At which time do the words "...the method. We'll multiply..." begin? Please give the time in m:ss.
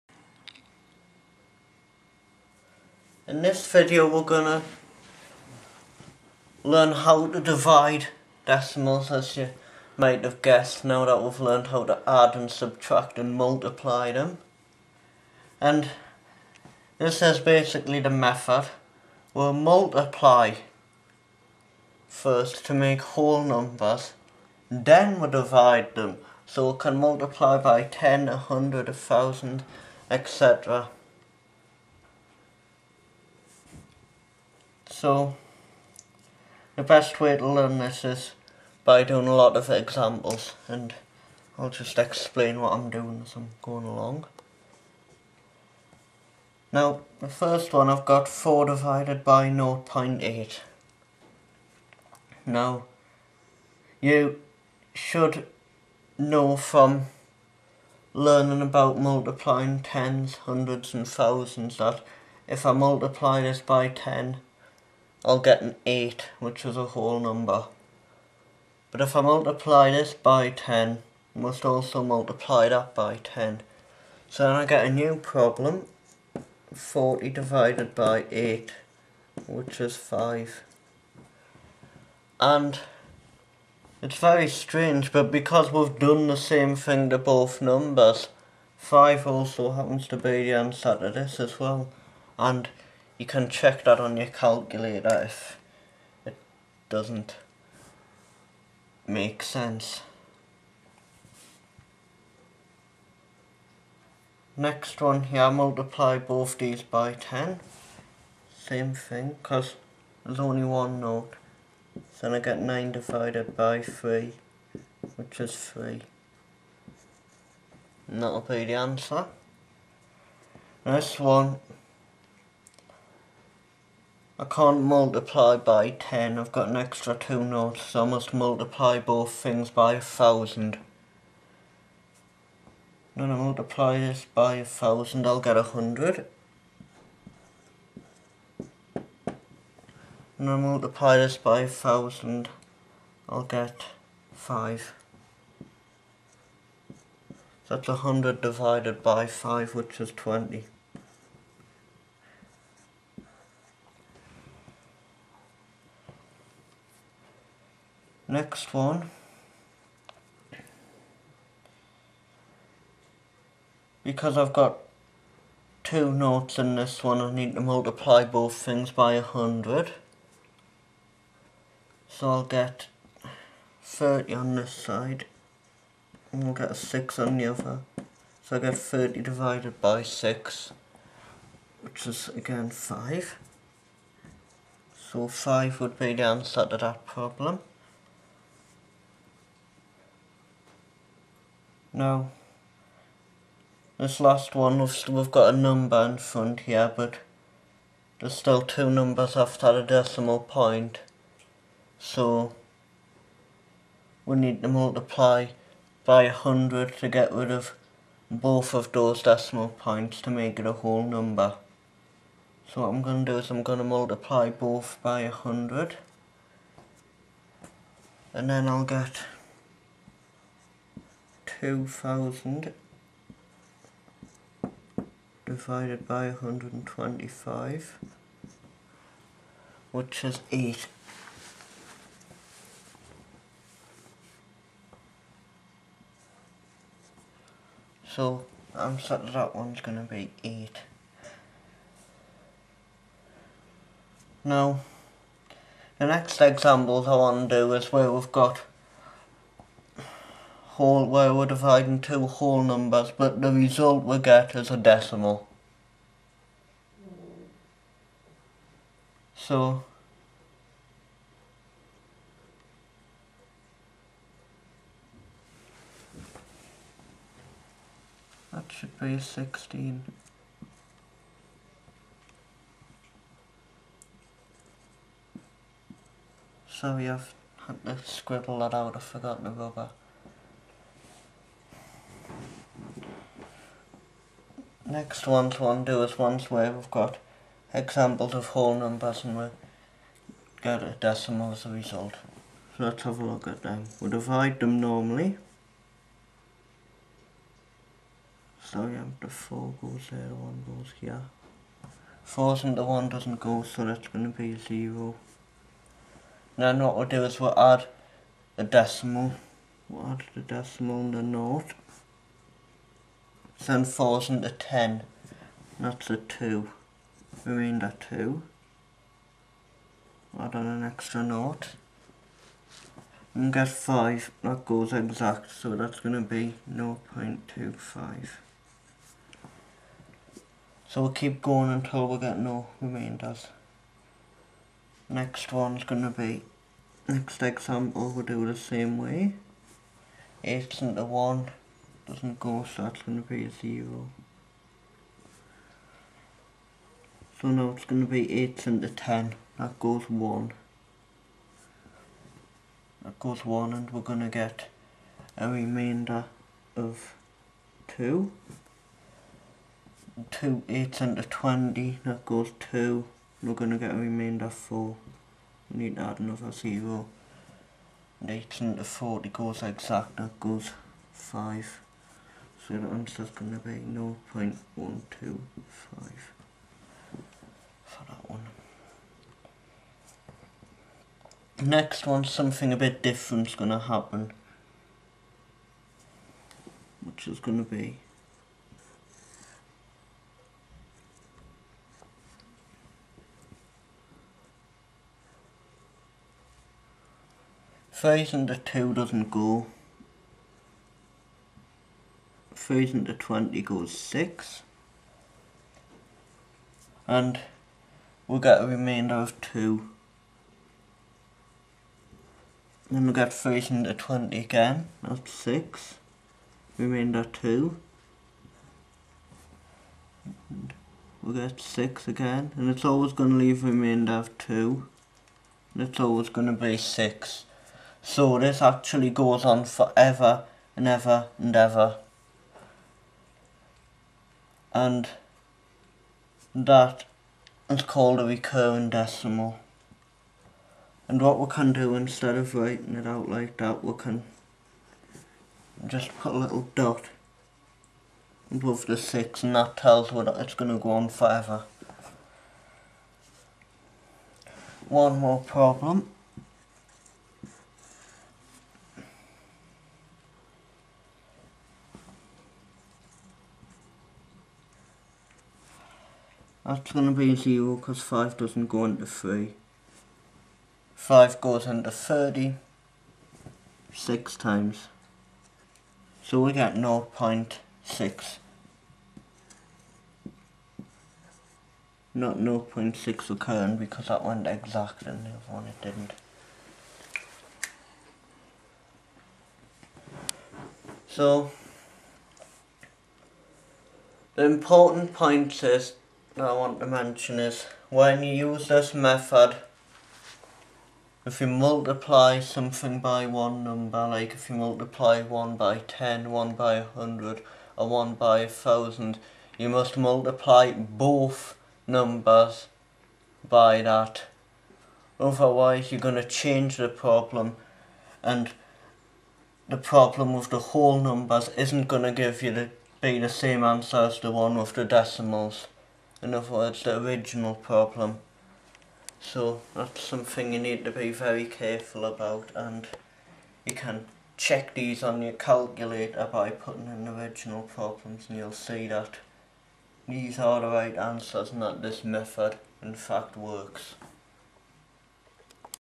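0:18.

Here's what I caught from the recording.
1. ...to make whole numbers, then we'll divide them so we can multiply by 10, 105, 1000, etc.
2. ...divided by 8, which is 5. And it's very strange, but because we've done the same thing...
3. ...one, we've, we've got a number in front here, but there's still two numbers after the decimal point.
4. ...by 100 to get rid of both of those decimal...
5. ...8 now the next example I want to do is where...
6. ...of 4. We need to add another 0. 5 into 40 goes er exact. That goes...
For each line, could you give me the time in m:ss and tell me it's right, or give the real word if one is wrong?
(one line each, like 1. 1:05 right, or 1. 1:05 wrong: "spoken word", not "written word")
1. 0:22 wrong: "100", not "105"
2. 1:17 right
3. 3:14 right
4. 3:26 right
5. 4:00 right
6. 6:04 wrong: "8", not "5".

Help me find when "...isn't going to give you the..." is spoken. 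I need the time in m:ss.
8:41.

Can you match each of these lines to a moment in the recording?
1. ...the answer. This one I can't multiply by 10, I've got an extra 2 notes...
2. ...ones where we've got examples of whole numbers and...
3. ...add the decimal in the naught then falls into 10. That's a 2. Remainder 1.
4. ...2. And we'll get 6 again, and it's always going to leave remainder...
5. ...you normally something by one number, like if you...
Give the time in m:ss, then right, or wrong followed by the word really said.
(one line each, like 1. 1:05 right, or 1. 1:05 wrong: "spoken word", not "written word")
1. 1:58 right
2. 4:46 right
3. 5:10 wrong: "2", not "1"
4. 6:57 right
5. 8:21 wrong: "multiply", not "normally".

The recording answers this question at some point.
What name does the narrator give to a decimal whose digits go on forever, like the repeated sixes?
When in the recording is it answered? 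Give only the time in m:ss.
7:18.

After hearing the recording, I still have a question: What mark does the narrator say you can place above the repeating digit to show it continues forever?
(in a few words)
a little dot.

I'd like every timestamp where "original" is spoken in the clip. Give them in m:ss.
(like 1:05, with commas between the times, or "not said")
8:47, 8:57.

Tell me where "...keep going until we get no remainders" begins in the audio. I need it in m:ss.
5:31.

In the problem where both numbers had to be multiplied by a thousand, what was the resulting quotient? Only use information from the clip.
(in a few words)
20.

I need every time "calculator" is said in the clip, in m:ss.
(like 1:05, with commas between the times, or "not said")
1:34, 8:55.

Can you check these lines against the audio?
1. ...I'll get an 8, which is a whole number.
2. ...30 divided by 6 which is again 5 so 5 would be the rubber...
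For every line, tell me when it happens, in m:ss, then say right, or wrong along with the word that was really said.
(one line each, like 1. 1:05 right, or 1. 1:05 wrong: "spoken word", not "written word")
1. 1:05 right
2. 2:58 wrong: "answer", not "rubber".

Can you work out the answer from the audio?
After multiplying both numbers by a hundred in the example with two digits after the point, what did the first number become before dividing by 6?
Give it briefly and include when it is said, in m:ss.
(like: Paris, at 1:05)
30, at 2:52.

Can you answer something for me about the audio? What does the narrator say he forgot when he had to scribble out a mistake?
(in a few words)
the rubber.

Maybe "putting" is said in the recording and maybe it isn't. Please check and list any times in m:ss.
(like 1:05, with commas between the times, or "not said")
8:56.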